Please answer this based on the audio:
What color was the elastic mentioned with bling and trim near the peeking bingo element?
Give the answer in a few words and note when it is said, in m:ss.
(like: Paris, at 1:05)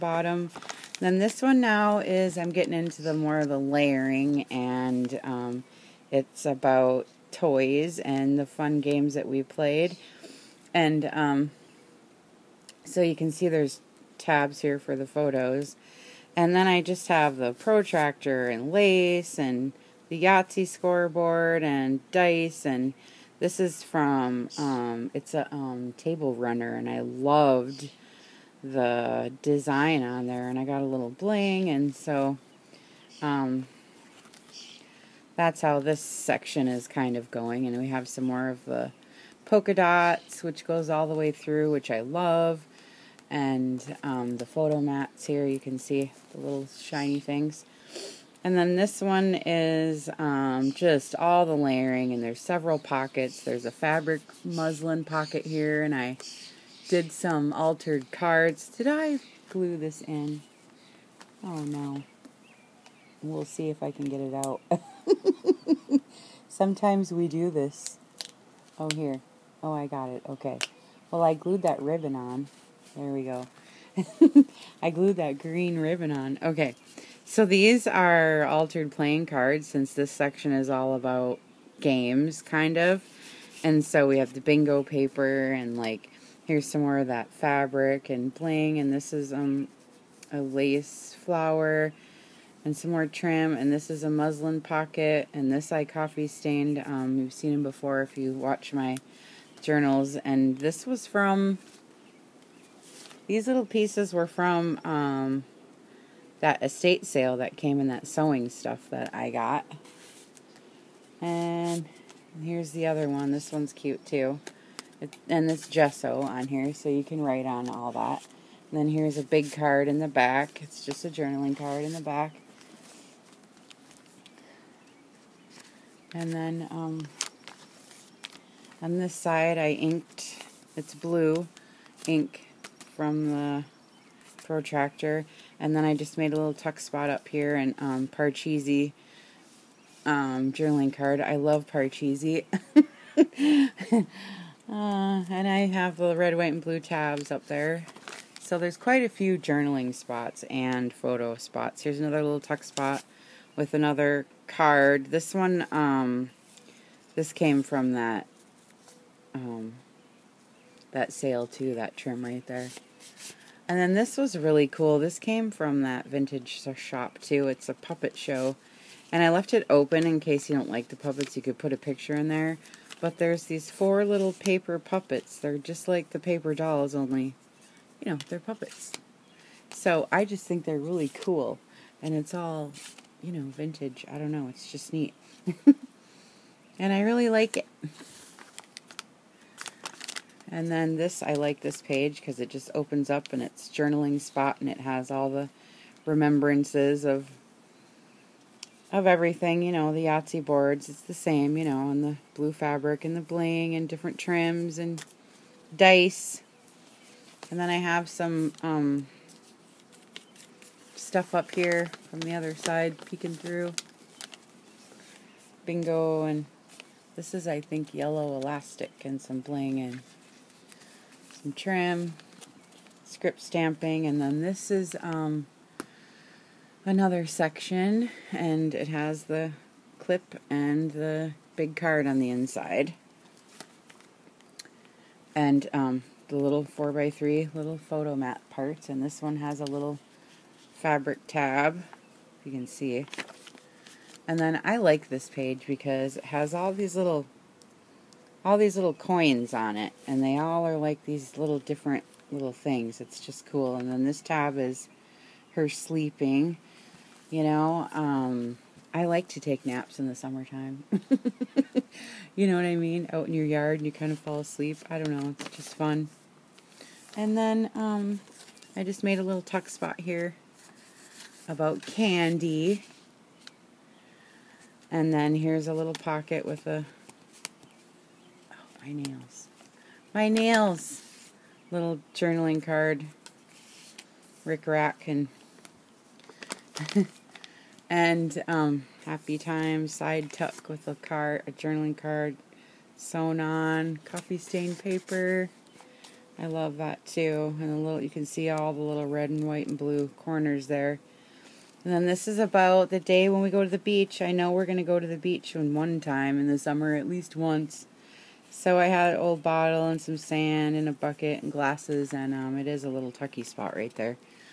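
Yellow, at 3:37.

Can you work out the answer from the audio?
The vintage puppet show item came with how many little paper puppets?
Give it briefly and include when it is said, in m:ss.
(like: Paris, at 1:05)
4, at 2:53.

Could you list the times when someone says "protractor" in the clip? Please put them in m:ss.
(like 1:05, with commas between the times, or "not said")
0:17, 2:14.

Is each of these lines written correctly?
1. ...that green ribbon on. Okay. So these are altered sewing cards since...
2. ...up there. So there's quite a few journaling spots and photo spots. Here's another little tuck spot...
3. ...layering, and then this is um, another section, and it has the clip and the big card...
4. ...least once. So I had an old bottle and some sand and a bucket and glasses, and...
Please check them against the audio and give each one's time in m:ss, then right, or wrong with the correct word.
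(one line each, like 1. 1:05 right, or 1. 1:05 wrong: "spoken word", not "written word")
1. 1:15 wrong: "playing", not "sewing"
2. 2:27 right
3. 3:43 wrong: "stamping", not "layering"
4. 5:07 right.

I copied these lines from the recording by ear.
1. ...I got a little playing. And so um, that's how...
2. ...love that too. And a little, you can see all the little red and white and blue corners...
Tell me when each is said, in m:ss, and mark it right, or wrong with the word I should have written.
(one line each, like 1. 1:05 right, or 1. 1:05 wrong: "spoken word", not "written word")
1. 0:30 wrong: "bling", not "playing"
2. 4:56 right.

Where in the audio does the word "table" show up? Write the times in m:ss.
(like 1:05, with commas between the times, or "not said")
0:25.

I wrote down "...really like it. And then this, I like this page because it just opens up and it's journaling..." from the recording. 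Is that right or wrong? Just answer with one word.
right.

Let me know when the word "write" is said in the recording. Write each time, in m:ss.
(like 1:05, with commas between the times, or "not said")
1:57.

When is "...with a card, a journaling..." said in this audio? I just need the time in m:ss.
4:50.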